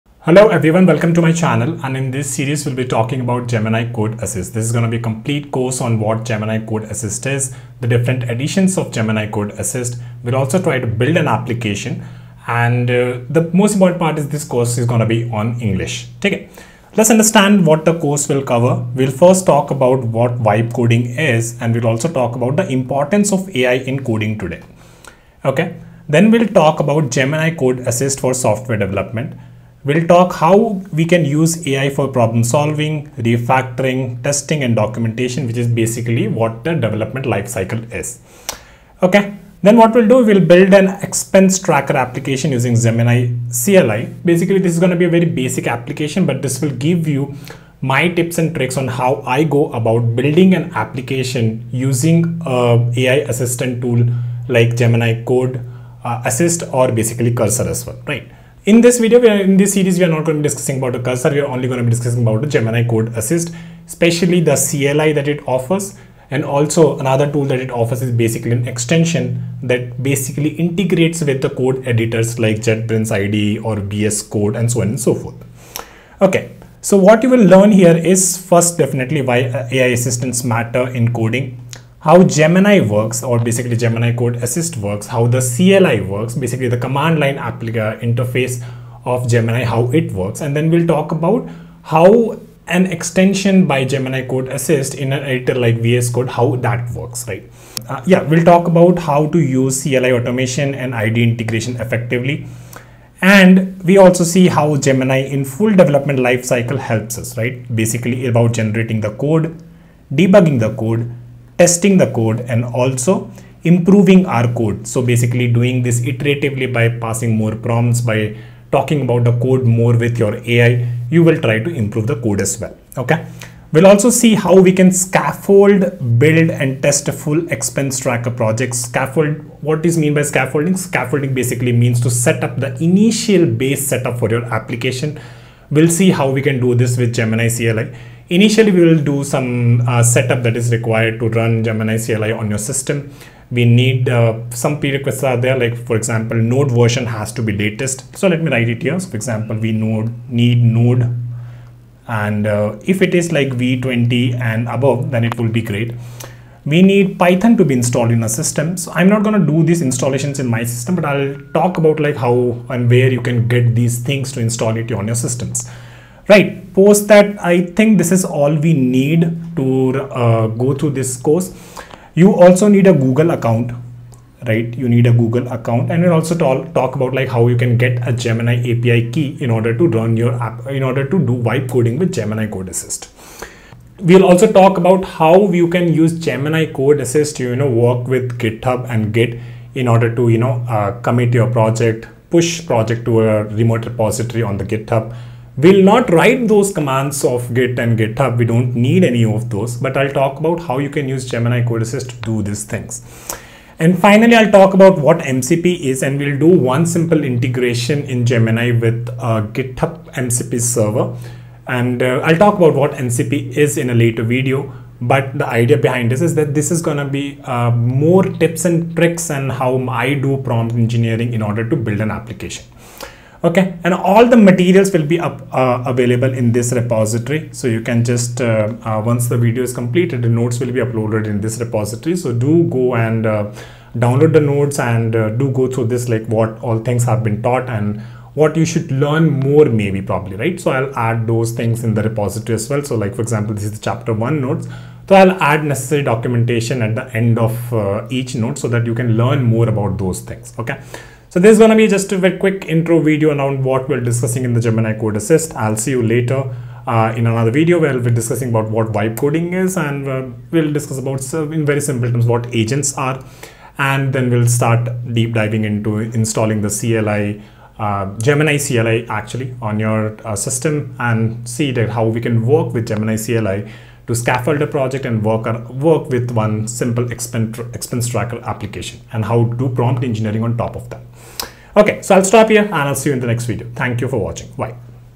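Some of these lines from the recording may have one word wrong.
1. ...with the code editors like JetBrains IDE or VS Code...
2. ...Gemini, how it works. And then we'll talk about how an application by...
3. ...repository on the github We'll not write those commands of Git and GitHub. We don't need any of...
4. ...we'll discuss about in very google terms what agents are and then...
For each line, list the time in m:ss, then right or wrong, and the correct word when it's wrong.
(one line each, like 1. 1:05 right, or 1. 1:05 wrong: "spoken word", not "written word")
1. 1:11 right
2. 1:29 wrong: "extension", not "application"
3. 3:13 right
4. 4:20 wrong: "simple", not "google".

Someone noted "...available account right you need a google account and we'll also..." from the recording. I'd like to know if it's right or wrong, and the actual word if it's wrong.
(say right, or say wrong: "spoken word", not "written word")
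wrong: "google", not "available".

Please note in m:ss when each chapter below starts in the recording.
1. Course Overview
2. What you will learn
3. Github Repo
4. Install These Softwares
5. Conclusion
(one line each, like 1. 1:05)
1. 0:20
2. 1:17
3. 3:44
4. 2:30
5. 4:18.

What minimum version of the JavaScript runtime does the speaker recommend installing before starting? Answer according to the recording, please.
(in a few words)
v20.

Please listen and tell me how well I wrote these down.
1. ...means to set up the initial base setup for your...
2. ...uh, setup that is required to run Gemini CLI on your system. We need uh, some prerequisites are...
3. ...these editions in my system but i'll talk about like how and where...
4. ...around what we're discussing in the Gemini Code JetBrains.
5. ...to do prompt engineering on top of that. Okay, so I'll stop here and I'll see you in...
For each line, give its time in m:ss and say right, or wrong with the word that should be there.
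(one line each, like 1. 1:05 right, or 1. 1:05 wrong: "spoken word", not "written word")
1. 2:11 right
2. 2:19 right
3. 2:39 wrong: "installations", not "editions"
4. 4:13 wrong: "Assist", not "JetBrains"
5. 4:39 right.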